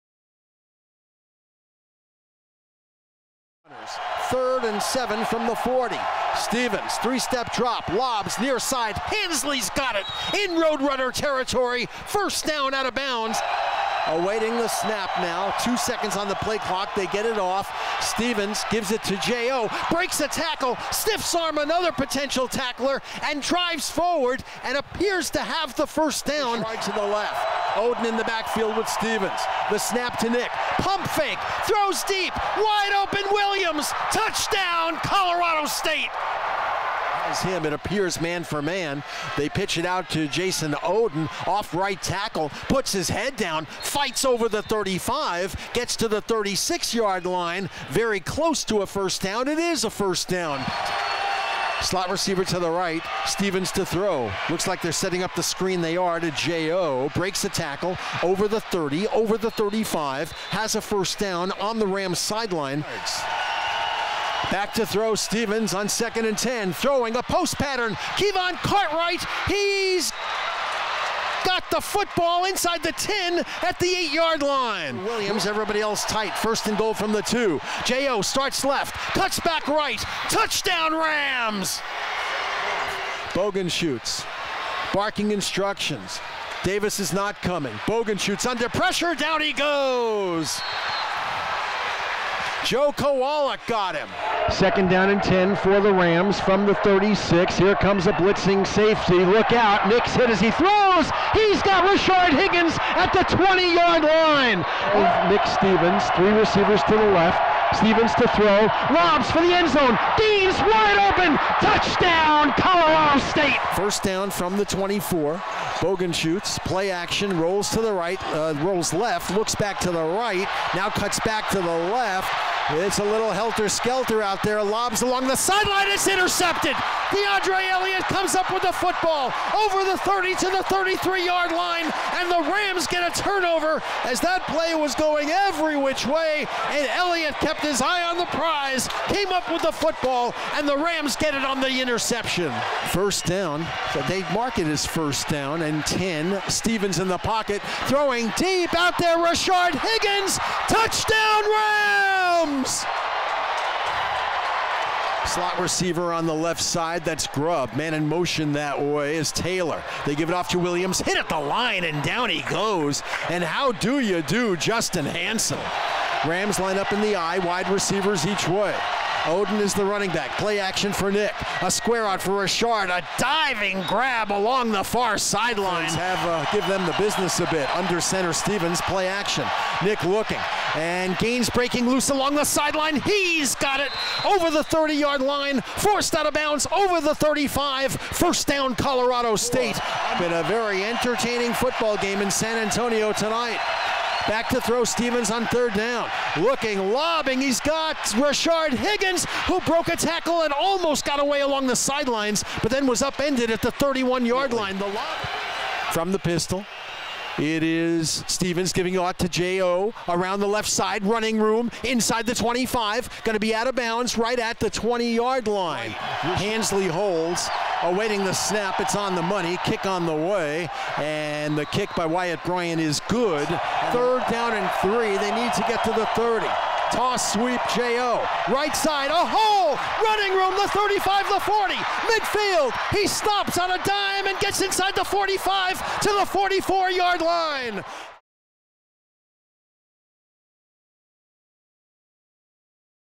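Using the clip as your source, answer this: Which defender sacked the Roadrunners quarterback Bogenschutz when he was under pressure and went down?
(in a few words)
Joe Kowalik.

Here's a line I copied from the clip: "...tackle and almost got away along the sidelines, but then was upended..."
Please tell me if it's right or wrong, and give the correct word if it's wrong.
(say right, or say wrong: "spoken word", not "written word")
right.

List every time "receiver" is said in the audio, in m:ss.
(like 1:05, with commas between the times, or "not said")
0:52, 1:46, 2:35, 2:47.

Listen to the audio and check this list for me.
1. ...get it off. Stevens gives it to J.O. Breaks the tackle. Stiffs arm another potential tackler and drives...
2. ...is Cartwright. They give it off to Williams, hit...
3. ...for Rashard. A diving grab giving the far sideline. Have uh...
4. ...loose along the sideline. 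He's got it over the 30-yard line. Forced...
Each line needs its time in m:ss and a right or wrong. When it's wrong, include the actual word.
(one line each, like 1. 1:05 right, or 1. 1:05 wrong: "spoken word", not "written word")
1. 0:17 right
2. 2:39 wrong: "Taylor", not "Cartwright"
3. 2:52 wrong: "along", not "giving"
4. 3:01 right.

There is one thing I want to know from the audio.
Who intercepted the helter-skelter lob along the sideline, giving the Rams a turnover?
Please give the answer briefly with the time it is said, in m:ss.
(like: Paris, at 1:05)
DeAndre Elliott, at 2:07.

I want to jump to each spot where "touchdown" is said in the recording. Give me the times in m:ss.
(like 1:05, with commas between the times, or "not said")
0:34, 1:20, 1:51, 2:30.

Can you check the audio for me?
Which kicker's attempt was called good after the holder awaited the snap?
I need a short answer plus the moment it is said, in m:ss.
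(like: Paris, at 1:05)
Wyatt Bryan, at 3:42.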